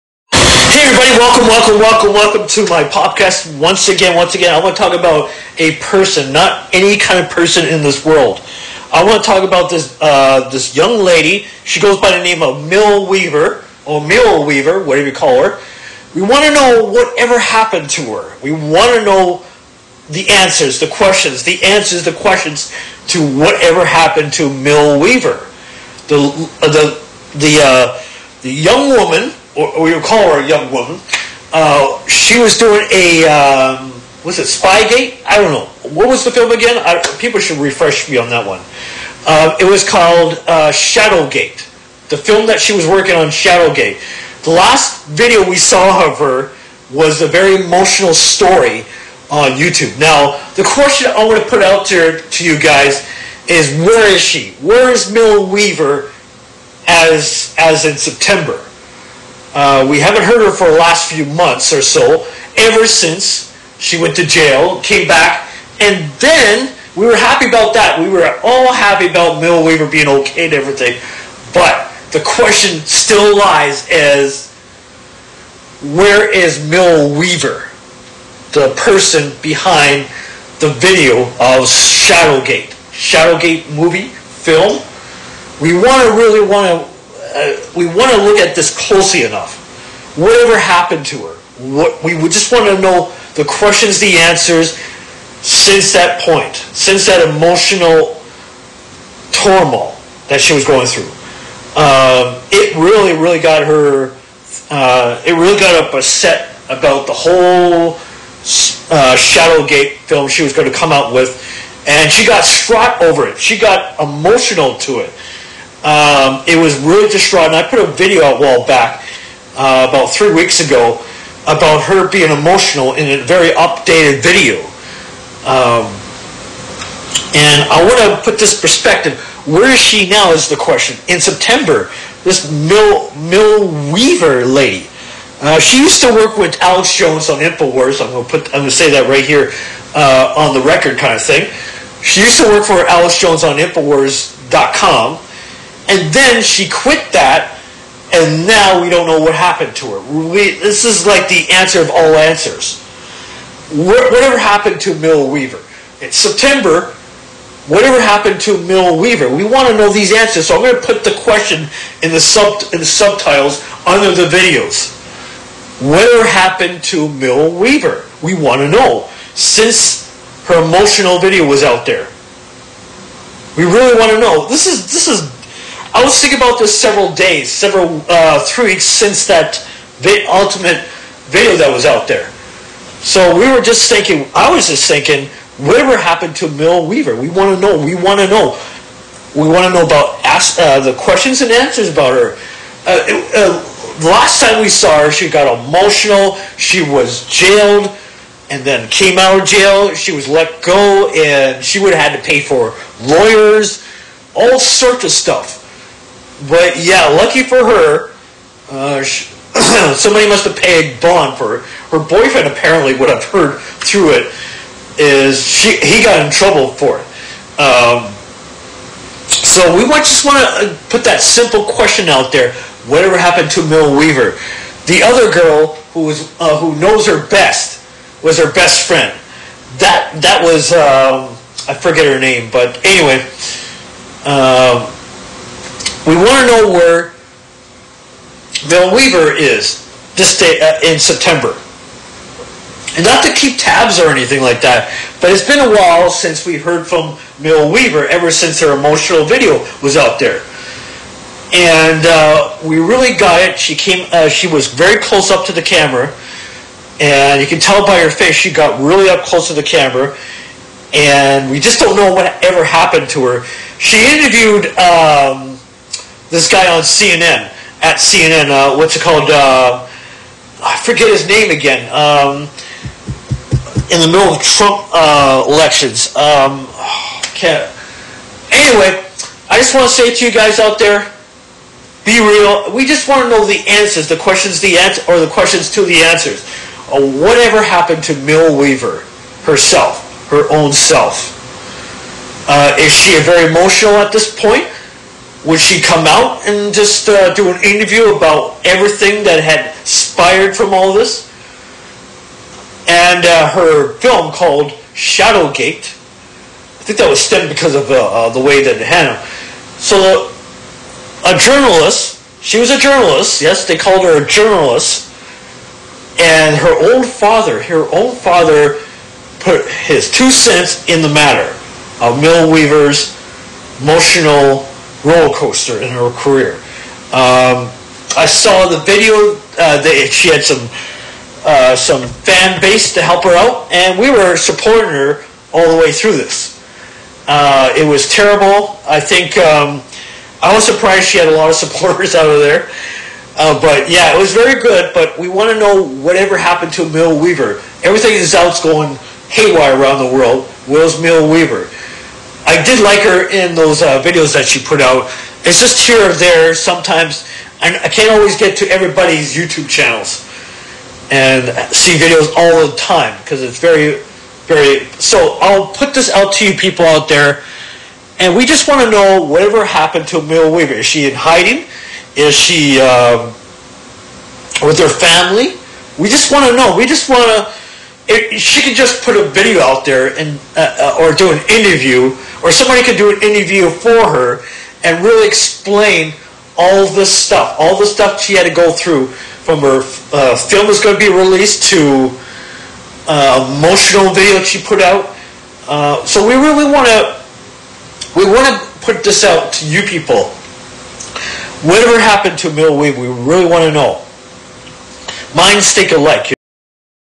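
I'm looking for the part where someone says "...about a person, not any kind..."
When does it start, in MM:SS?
00:04.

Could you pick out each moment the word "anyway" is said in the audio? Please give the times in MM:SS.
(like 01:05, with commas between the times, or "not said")
03:52, 04:38.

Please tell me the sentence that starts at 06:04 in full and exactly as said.
So I'll put this out to you people out there, and we just want to know whatever happened to Mill Weaver.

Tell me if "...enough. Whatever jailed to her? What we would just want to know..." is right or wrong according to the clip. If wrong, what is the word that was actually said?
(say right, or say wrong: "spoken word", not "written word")
wrong: "happened", not "jailed".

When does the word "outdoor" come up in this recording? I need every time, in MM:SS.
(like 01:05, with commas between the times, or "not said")
not said.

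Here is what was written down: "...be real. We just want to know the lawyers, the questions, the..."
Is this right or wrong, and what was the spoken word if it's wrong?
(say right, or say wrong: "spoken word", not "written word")
wrong: "answers", not "lawyers".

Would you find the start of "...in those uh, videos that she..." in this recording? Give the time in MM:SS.
05:53.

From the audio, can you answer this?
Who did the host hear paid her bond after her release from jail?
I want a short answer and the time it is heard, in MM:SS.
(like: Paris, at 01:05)
Her boyfriend, at 03:31.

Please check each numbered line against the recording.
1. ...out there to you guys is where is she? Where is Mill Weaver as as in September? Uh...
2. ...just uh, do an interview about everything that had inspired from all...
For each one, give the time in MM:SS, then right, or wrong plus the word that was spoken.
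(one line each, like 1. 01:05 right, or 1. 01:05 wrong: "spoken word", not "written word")
1. 00:51 right
2. 04:56 right.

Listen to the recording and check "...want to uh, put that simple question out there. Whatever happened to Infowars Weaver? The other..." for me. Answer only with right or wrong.
wrong.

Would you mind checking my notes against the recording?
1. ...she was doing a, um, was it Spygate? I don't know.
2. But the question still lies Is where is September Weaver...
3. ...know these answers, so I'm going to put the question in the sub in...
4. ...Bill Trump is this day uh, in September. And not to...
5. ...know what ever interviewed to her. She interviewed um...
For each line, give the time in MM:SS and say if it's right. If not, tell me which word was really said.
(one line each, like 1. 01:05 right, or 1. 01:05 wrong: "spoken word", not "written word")
1. 00:32 right
2. 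01:11 wrong: "Mill", not "September"
3. 02:39 right
4. 03:58 wrong: "Weaver", not "Trump"
5. 04:21 wrong: "happened", not "interviewed".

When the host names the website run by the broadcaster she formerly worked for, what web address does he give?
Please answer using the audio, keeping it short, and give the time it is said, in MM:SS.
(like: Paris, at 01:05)
Infowars.com, at 02:23.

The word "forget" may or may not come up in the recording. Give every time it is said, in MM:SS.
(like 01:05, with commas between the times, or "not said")
03:51, 04:30.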